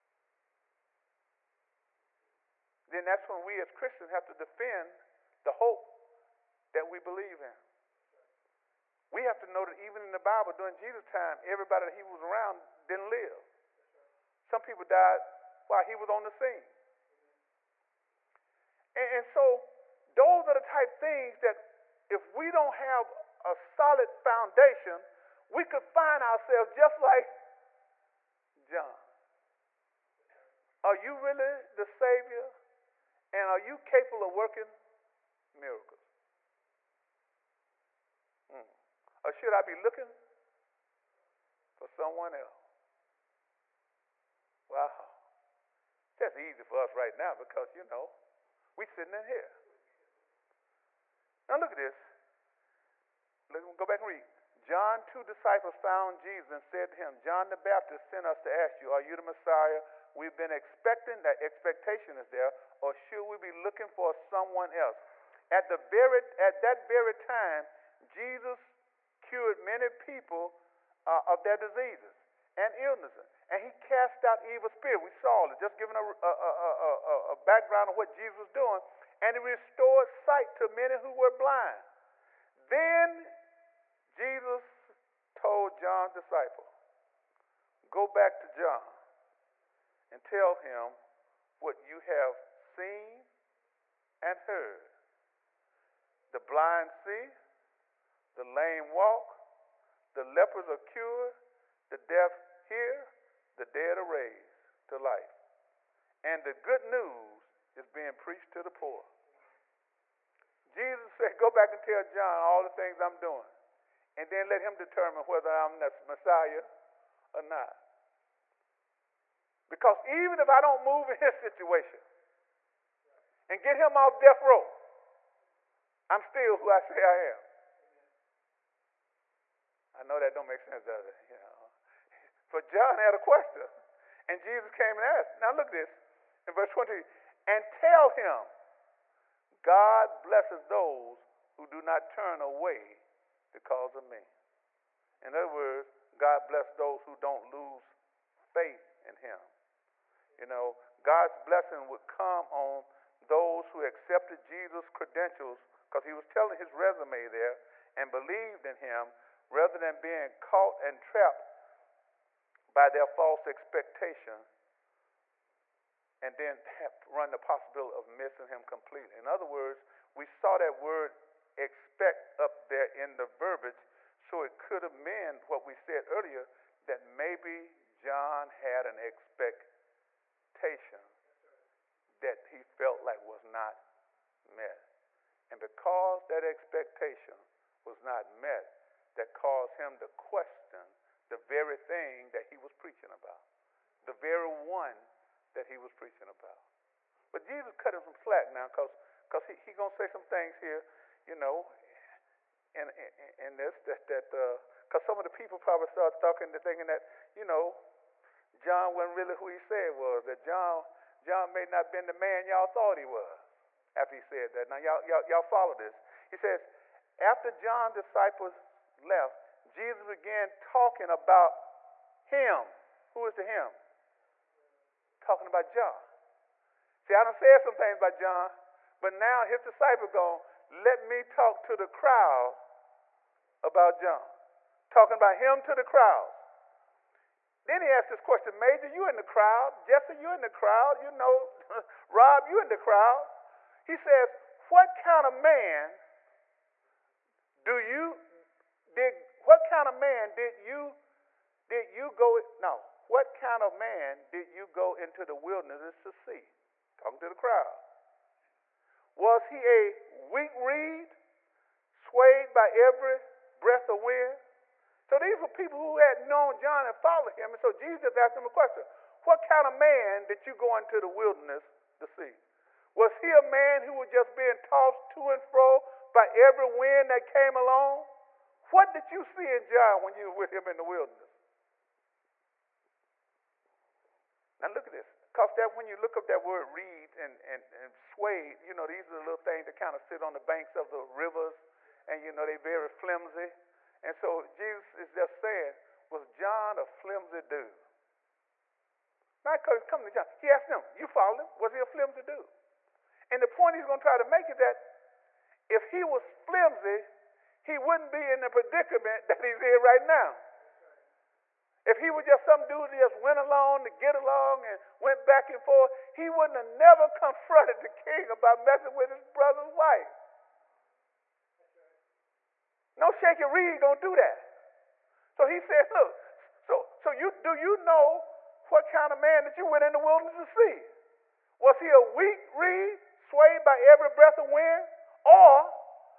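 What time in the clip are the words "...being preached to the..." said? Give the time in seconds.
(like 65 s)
107 s.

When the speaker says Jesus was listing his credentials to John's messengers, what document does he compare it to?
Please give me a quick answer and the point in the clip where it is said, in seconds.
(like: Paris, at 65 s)
His resume, at 156 s.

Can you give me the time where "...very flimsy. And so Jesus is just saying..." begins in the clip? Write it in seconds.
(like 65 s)
292 s.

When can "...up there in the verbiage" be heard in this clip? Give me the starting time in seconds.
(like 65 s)
172 s.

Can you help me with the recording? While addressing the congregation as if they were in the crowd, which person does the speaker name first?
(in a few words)
Major.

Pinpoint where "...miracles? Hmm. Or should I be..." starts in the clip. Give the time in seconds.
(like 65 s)
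35 s.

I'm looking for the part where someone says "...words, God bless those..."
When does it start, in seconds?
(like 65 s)
145 s.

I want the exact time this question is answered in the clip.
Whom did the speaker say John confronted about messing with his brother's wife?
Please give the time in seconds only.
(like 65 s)
317 s.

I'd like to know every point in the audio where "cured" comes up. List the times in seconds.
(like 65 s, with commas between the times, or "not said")
69 s, 100 s.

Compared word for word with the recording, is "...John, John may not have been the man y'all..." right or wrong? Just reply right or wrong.
right.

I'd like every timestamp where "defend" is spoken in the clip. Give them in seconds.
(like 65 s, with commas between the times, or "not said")
4 s.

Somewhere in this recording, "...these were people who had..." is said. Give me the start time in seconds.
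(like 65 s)
265 s.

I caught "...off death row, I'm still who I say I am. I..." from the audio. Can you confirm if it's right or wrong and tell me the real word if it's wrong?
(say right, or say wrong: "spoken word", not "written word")
right.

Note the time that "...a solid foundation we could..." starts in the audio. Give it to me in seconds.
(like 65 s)
23 s.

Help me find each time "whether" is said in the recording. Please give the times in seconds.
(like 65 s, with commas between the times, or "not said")
115 s.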